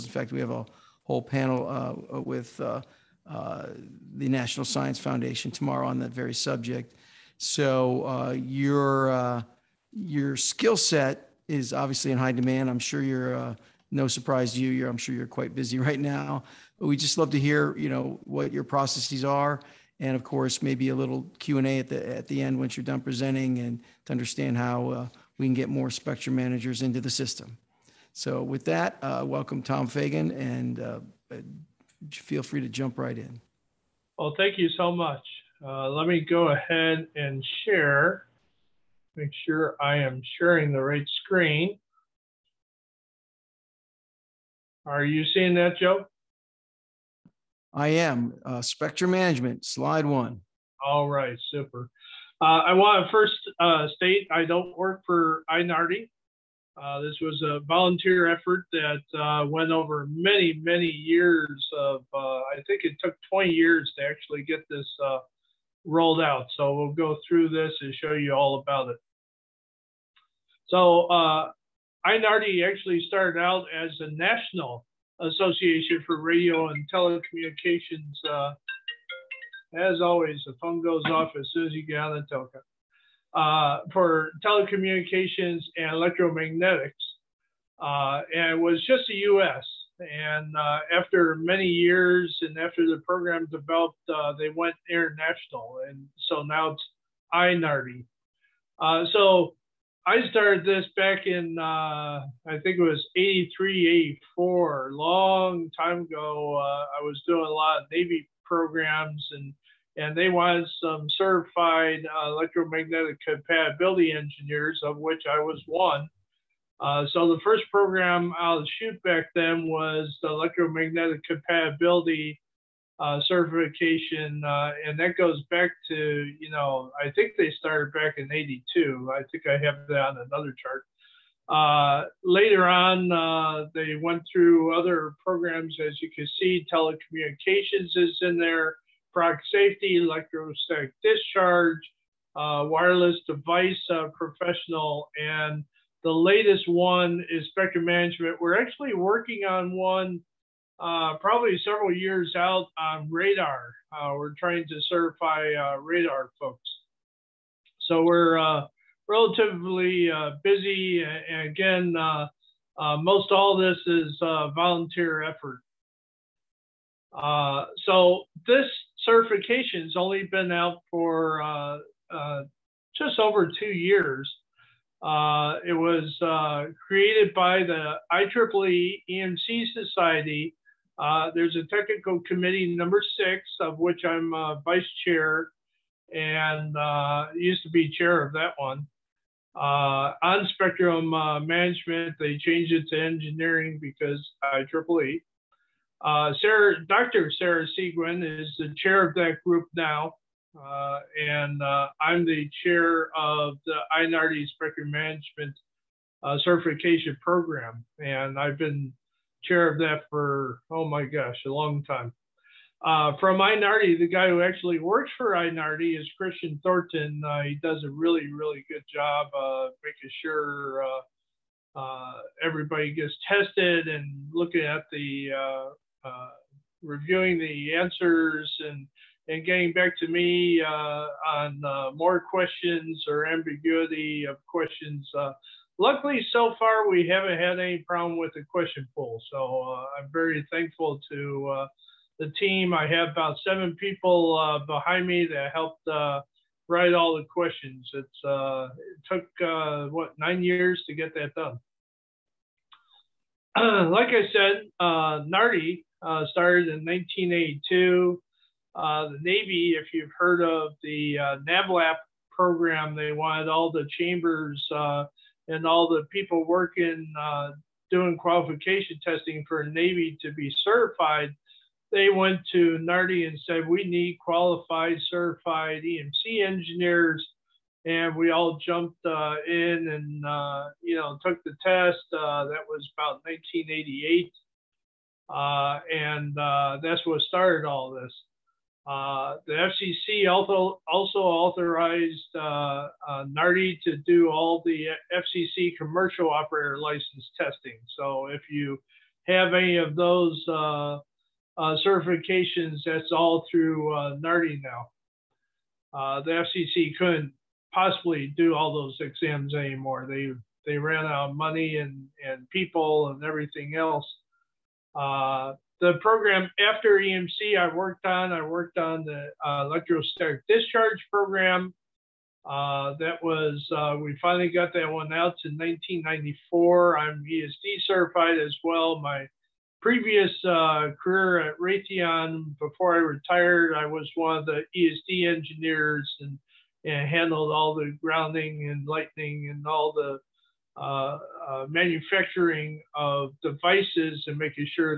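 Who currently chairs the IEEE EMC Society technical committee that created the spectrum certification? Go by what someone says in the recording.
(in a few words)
Dr. Sarah Seguin.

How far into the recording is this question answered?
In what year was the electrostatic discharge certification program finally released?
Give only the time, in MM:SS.
05:25.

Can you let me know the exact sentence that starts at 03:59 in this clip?
So uh, I'm very thankful to uh, the team.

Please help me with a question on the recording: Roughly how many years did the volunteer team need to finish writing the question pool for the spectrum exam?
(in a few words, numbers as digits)
9.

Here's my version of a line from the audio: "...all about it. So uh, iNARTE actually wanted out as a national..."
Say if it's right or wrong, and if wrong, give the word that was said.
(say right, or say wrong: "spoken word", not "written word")
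wrong: "started", not "wanted".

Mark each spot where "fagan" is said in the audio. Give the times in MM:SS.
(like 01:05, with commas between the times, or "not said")
00:29.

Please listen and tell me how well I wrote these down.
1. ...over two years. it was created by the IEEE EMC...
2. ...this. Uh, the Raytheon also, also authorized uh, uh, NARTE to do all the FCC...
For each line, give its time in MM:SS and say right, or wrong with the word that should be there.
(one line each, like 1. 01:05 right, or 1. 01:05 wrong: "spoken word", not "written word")
1. 02:53 right
2. 04:47 wrong: "FCC", not "Raytheon".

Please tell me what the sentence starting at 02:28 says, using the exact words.
We're actually working on one uh, probably several years out on radar.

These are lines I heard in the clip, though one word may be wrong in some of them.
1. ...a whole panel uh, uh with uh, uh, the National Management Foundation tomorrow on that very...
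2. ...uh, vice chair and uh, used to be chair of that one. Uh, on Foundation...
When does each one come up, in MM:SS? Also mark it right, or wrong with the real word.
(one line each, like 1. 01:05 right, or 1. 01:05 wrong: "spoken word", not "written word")
1. 00:00 wrong: "Science", not "Management"
2. 03:04 wrong: "Spectrum", not "Foundation".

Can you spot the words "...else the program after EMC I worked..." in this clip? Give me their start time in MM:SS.
05:13.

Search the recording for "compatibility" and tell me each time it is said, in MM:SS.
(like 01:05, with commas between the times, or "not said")
01:53, 02:01.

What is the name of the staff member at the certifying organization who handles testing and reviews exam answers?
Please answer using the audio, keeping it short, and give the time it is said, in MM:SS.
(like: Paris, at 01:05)
Christian Thornton, at 03:36.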